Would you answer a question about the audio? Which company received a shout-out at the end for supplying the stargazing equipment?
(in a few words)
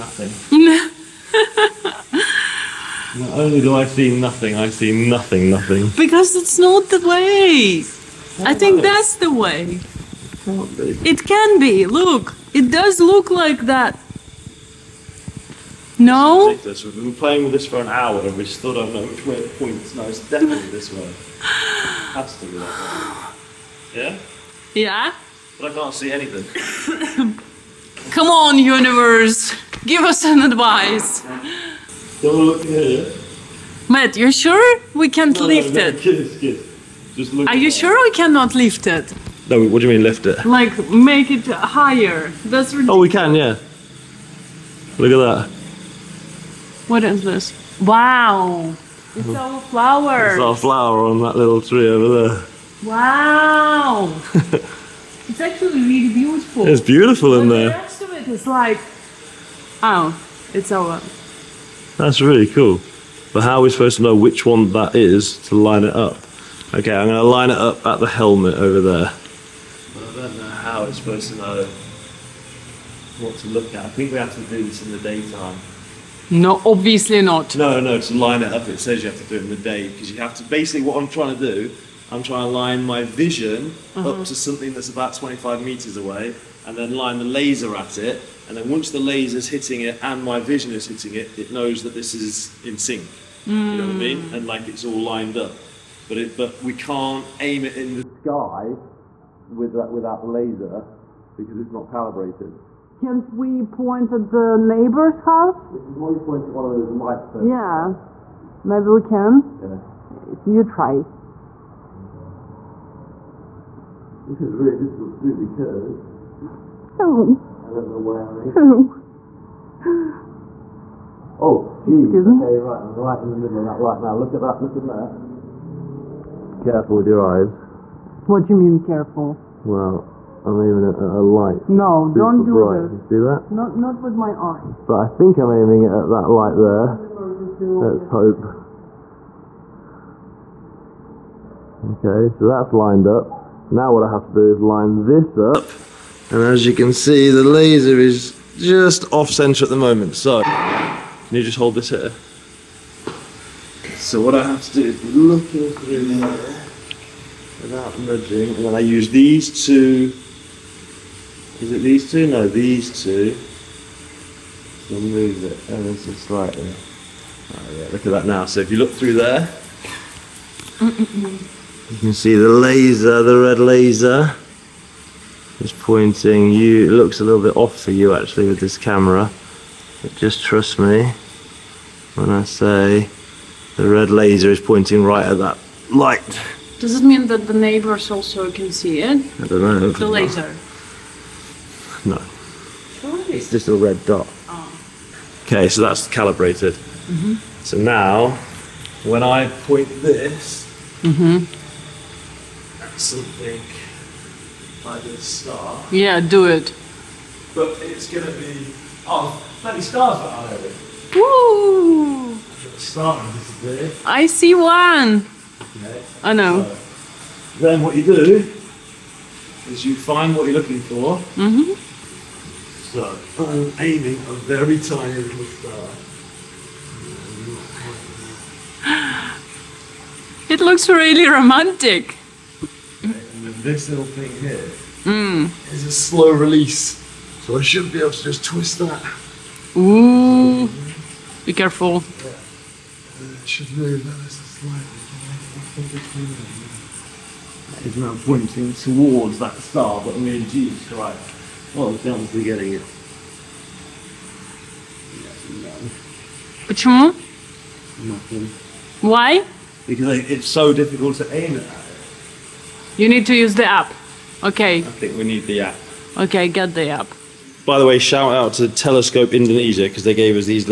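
Telescope Indonesia.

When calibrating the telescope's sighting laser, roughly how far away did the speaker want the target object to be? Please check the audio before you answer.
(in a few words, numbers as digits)
25 meters.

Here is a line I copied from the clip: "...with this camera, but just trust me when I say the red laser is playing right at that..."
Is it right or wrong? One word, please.
wrong.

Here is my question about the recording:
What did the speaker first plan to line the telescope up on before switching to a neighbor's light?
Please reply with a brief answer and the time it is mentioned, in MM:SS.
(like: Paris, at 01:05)
the helmet, at 01:07.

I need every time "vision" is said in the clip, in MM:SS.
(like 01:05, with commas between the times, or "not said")
01:23, 01:30.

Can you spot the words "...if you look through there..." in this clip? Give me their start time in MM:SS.
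02:48.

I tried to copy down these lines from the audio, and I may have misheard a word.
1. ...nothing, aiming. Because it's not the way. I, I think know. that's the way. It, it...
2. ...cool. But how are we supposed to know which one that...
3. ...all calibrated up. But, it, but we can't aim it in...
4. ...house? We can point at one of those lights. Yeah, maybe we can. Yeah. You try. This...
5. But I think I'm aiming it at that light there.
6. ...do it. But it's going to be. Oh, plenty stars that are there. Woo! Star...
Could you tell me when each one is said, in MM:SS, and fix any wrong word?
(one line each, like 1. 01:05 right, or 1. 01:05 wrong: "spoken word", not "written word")
1. 00:05 wrong: "nothing", not "aiming"
2. 01:02 right
3. 01:34 wrong: "lined", not "calibrated"
4. 01:45 right
5. 02:14 right
6. 03:26 right.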